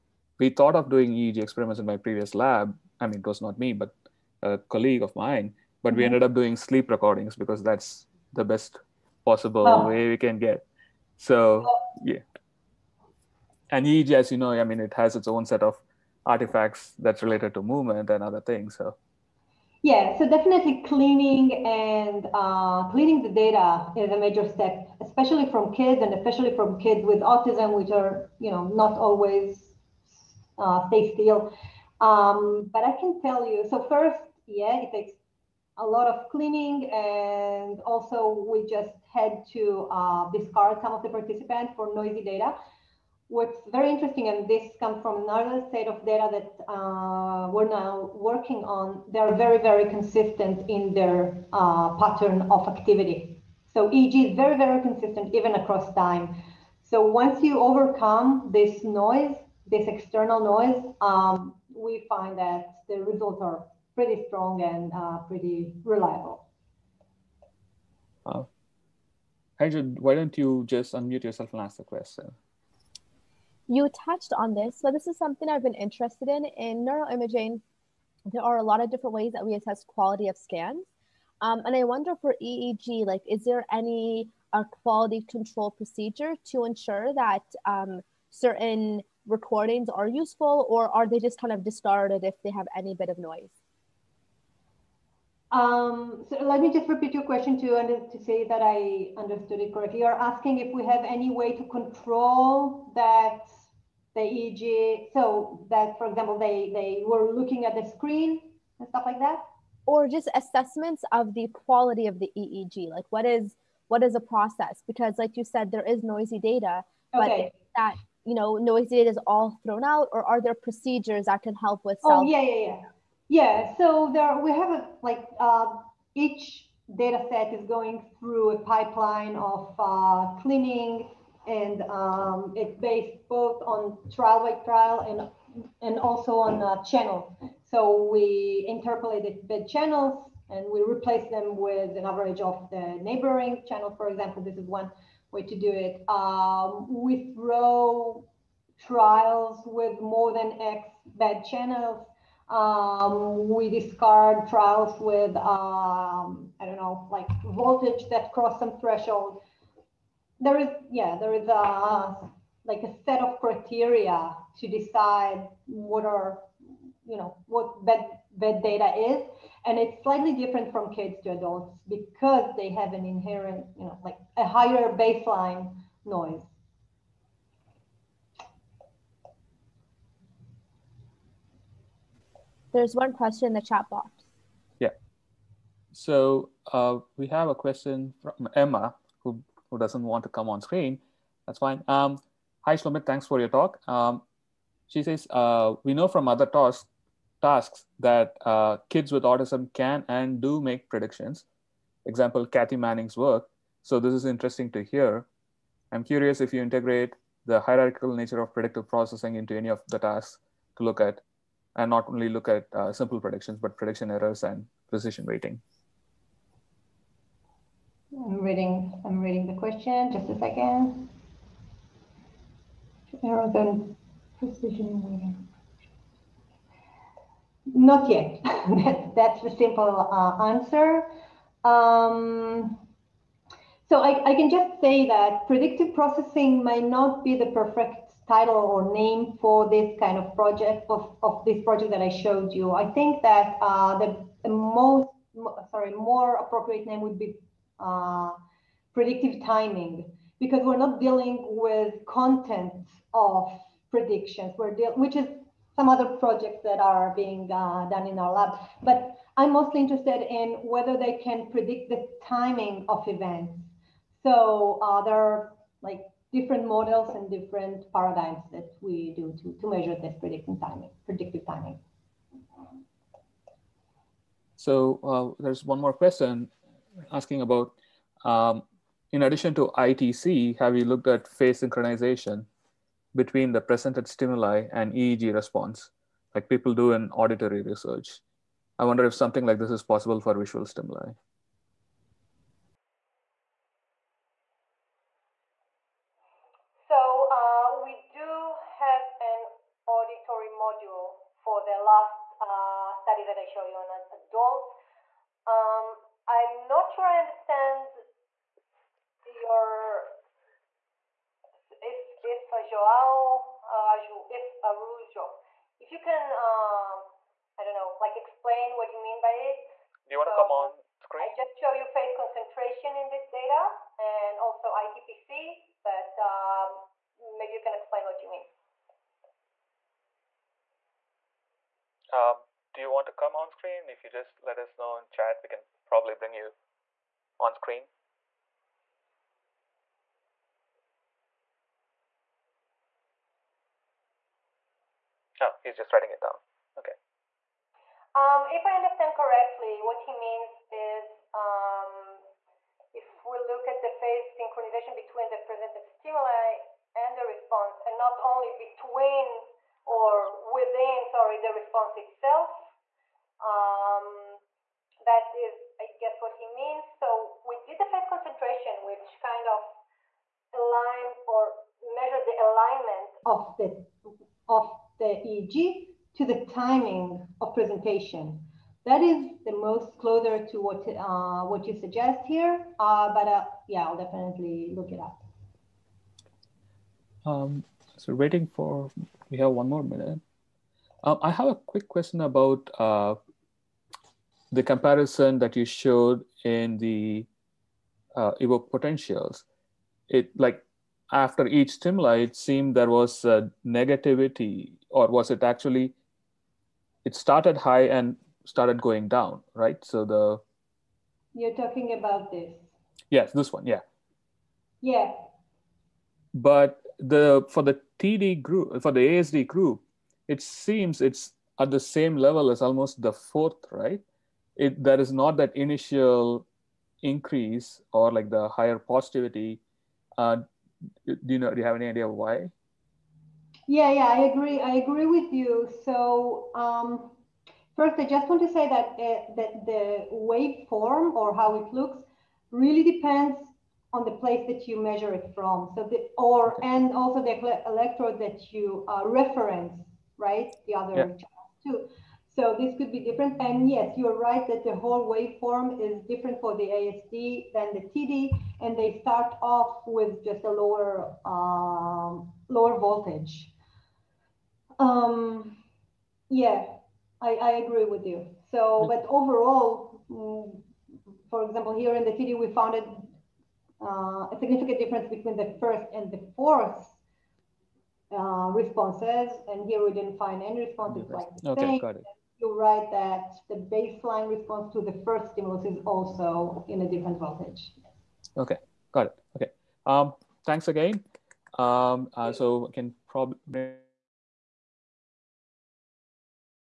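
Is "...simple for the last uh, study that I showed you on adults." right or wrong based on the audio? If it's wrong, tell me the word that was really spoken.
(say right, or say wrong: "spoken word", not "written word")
wrong: "module", not "simple".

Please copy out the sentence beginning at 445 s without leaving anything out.
So the, or, and also the electrode that you uh, reference, right?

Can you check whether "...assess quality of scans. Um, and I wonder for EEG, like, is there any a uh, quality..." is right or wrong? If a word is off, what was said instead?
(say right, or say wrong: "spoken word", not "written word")
right.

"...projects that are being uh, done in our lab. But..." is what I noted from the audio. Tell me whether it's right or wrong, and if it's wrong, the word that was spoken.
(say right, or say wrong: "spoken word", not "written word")
right.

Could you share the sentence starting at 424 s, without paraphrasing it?
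It there is not that initial increase or like the higher positivity.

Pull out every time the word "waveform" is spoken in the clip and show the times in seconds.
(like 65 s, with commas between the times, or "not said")
440 s, 455 s.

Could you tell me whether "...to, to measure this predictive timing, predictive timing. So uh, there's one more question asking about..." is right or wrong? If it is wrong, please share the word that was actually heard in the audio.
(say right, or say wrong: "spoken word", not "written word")
right.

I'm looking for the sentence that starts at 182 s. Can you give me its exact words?
There's one question in the chat box.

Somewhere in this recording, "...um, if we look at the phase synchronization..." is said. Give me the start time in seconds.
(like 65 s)
351 s.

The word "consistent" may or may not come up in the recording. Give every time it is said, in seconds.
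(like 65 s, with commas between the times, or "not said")
49 s, 54 s.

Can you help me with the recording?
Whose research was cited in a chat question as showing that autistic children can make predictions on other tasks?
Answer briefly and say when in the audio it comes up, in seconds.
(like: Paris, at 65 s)
Kathy Manning, at 202 s.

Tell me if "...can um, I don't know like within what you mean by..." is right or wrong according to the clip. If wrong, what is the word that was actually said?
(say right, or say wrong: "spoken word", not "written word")
wrong: "explain", not "within".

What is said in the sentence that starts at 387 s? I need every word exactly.
Um, so waiting for, we have one more minute.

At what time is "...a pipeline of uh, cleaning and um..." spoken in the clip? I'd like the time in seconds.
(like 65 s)
128 s.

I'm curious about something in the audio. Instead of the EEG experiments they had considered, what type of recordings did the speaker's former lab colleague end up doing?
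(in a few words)
Sleep recordings.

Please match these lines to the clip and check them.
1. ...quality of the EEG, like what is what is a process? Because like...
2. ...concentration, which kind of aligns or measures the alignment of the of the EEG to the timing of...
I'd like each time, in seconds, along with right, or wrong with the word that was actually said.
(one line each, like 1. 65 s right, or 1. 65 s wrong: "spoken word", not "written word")
1. 111 s right
2. 368 s right.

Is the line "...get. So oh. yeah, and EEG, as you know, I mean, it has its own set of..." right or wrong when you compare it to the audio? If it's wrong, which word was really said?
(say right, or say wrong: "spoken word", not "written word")
right.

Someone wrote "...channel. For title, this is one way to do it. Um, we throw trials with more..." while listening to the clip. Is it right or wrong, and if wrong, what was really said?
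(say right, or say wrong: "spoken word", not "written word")
wrong: "example", not "title".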